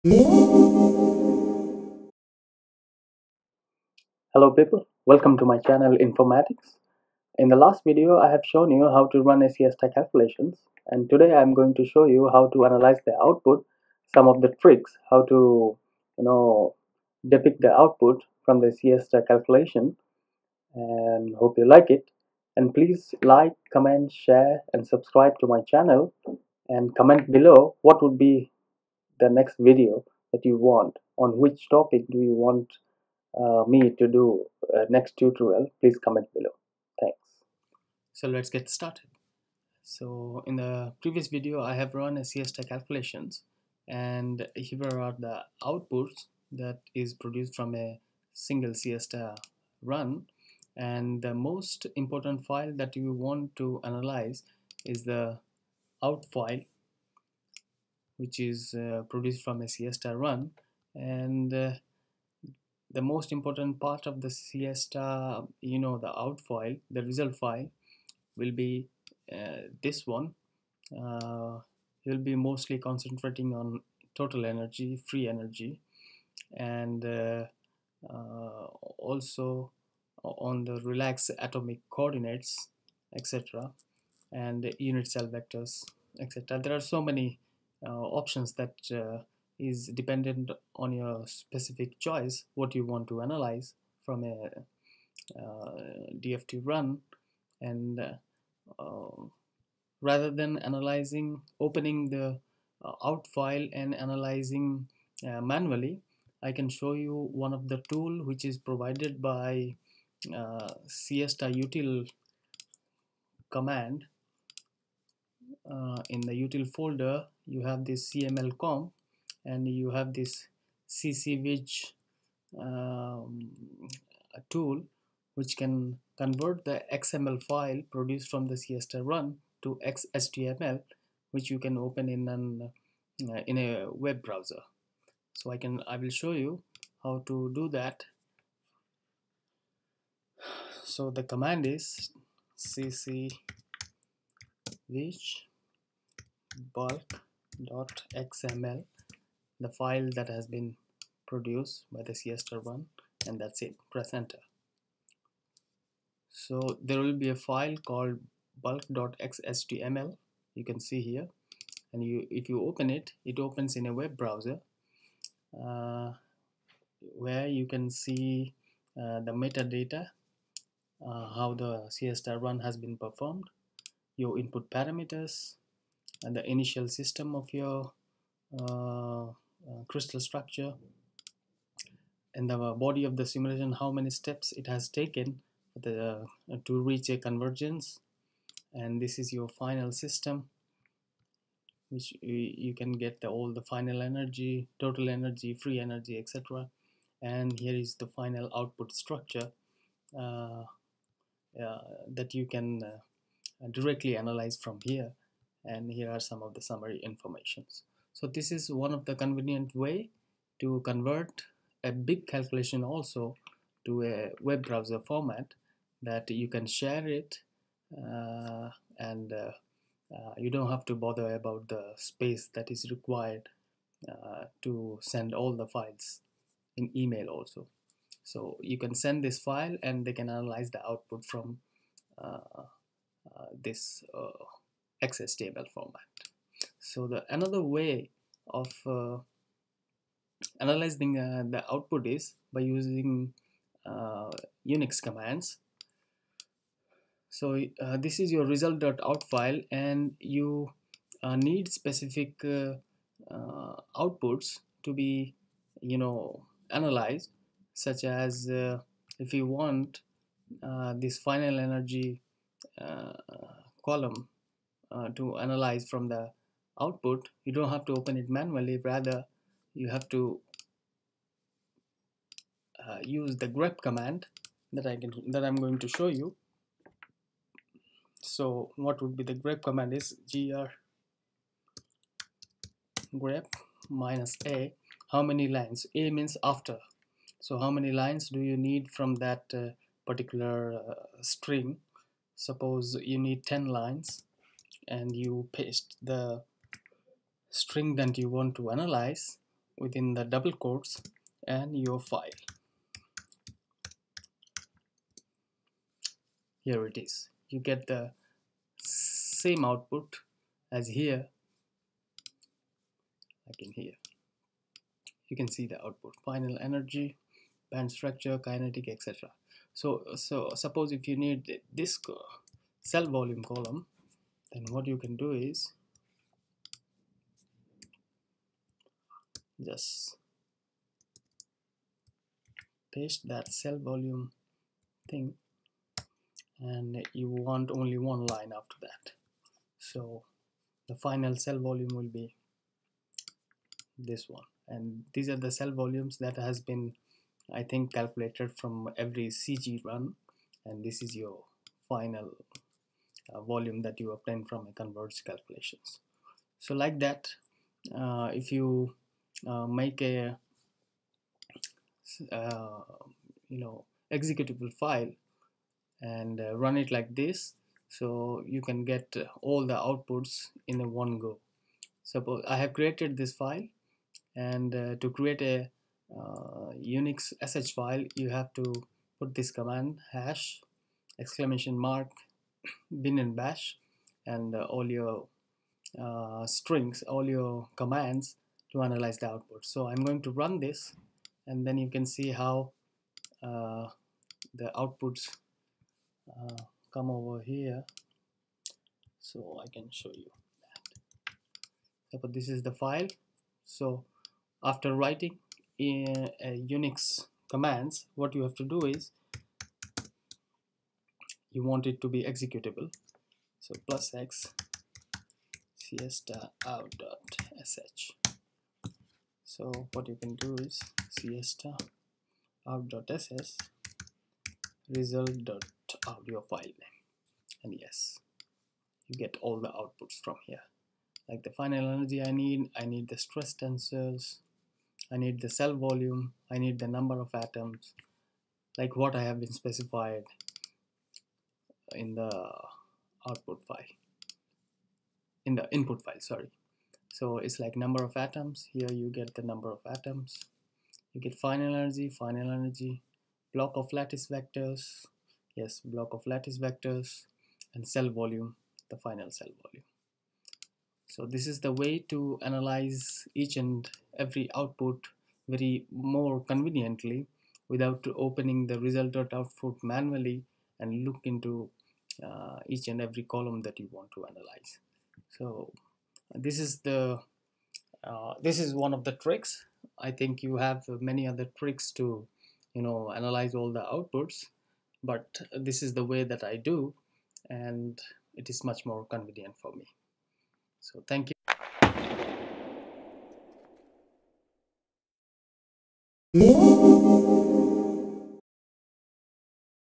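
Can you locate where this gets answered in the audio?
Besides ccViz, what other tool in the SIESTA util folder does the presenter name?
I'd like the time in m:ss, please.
1:58.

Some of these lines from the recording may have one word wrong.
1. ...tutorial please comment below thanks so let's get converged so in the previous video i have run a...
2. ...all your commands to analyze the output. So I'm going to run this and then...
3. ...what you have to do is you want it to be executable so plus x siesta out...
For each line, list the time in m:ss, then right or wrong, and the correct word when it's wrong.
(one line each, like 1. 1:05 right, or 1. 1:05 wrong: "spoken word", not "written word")
1. 0:35 wrong: "started", not "converged"
2. 6:27 right
3. 6:48 right.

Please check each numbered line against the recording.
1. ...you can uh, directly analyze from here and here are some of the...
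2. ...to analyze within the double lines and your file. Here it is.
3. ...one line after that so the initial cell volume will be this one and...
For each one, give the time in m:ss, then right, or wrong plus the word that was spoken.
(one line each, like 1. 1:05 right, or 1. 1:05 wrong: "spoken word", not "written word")
1. 3:22 right
2. 4:58 wrong: "quotes", not "lines"
3. 5:37 wrong: "final", not "initial".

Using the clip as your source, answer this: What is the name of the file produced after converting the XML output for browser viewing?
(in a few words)
bulk.xhtml.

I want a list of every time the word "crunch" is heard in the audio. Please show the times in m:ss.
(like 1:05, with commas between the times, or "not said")
not said.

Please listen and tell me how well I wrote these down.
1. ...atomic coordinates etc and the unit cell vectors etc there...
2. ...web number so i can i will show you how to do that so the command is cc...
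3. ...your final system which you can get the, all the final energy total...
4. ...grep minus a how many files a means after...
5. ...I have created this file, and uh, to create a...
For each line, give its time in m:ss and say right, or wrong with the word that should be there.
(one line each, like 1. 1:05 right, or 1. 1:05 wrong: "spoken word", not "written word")
1. 1:21 right
2. 2:13 wrong: "browser", not "number"
3. 3:09 right
4. 4:43 wrong: "lines", not "files"
5. 6:12 right.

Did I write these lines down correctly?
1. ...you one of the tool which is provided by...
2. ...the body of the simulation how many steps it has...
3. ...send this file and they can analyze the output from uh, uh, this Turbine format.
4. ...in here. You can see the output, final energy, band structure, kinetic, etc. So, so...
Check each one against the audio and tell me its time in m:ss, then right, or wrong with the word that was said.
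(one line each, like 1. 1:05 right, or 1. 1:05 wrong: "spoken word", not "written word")
1. 1:46 right
2. 3:02 right
3. 3:48 wrong: "XHTML", not "Turbine"
4. 5:13 right.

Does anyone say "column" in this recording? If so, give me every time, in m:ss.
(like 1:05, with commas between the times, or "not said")
4:23, 5:23, 7:53.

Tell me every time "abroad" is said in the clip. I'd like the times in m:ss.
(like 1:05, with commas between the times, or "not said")
not said.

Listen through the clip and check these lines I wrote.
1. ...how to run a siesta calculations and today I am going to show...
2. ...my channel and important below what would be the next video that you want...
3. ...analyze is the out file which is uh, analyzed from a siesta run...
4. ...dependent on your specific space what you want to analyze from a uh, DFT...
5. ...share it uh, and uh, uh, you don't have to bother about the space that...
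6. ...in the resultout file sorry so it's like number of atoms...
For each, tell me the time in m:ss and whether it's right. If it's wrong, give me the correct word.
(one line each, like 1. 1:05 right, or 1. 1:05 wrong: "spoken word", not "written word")
1. 0:08 right
2. 0:25 wrong: "comment", not "important"
3. 0:53 wrong: "produced", not "analyzed"
4. 1:29 wrong: "choice", not "space"
5. 3:36 right
6. 7:25 wrong: "input", not "resultout".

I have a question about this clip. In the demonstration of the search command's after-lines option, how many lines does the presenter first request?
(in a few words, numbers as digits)
10.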